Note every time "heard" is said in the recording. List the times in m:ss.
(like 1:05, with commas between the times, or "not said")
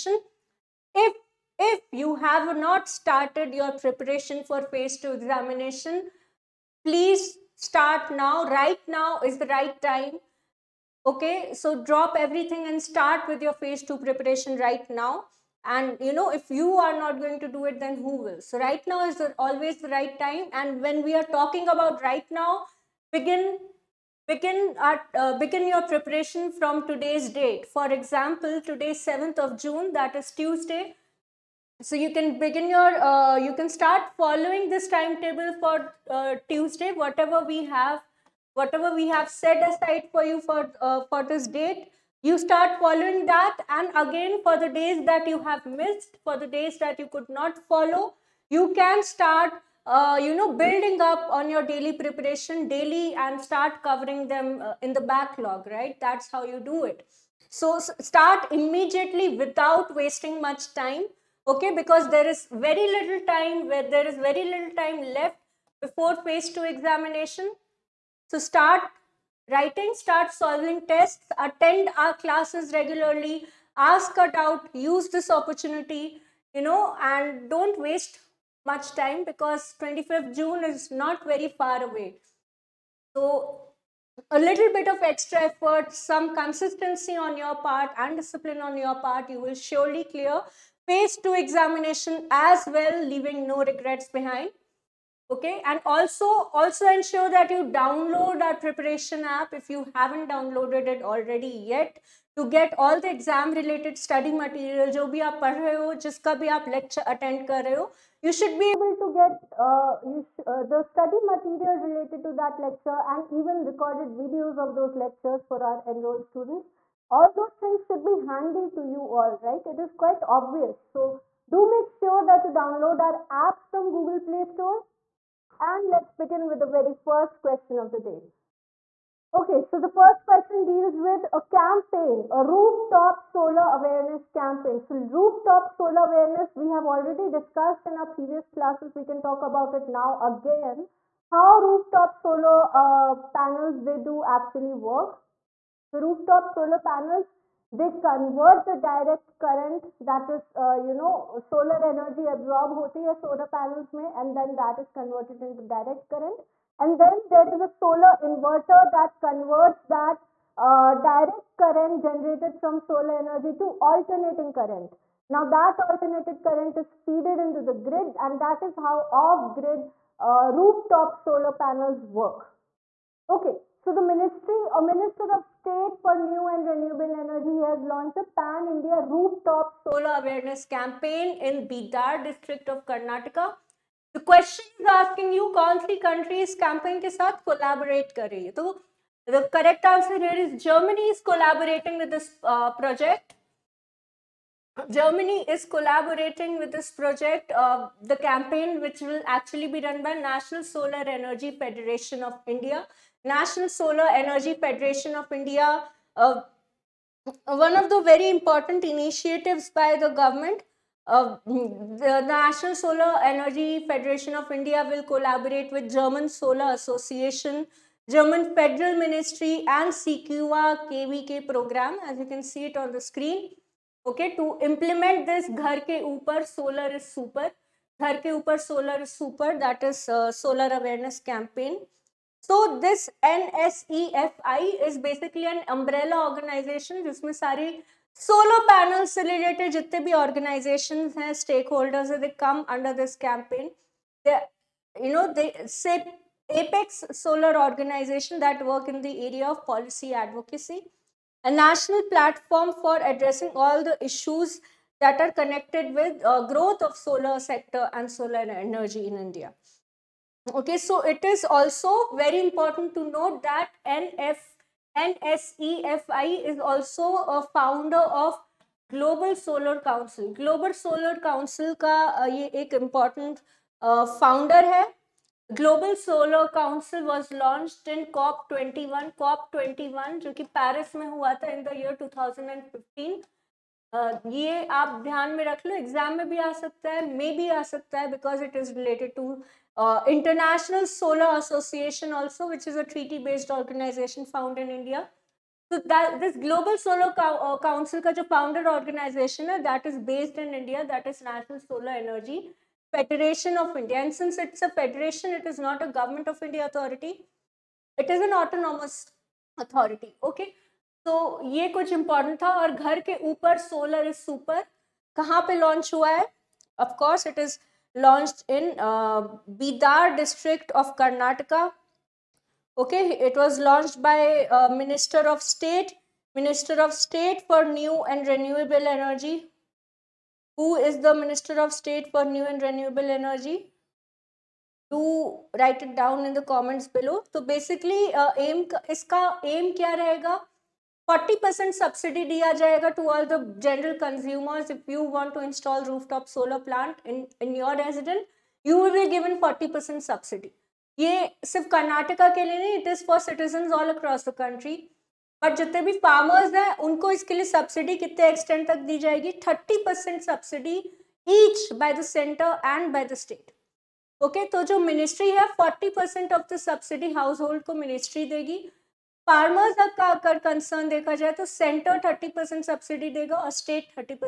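not said.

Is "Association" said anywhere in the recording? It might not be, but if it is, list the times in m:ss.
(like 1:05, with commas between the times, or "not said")
3:36, 4:51.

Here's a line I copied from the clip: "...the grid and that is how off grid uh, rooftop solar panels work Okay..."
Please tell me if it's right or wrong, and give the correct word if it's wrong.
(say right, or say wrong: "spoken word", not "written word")
right.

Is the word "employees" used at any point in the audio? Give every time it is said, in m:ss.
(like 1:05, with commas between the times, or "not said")
not said.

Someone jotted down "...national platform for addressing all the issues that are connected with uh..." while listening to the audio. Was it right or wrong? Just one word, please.
right.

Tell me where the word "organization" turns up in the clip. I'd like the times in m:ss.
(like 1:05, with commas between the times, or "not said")
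3:56, 4:07, 4:53, 4:58.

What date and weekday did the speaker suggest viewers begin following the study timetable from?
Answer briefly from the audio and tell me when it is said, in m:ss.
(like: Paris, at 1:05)
7th of June, Tuesday, at 0:29.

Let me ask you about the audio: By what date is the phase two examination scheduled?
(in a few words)
25th June.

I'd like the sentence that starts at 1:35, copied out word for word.
Okay, and also also ensure that you download our preparation app if you haven't downloaded it already yet.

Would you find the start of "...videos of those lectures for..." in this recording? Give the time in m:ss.
1:54.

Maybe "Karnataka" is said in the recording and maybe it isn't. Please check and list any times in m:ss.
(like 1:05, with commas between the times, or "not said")
3:02, 5:20.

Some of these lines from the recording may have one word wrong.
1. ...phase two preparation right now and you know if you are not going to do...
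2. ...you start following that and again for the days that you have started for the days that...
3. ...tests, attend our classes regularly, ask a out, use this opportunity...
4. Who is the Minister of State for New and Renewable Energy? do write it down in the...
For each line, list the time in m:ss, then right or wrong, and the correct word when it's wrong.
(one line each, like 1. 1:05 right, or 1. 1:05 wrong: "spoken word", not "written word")
1. 0:13 right
2. 0:42 wrong: "missed", not "started"
3. 1:10 right
4. 5:30 right.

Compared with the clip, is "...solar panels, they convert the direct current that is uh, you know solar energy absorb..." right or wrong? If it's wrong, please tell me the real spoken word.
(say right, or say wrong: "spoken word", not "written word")
right.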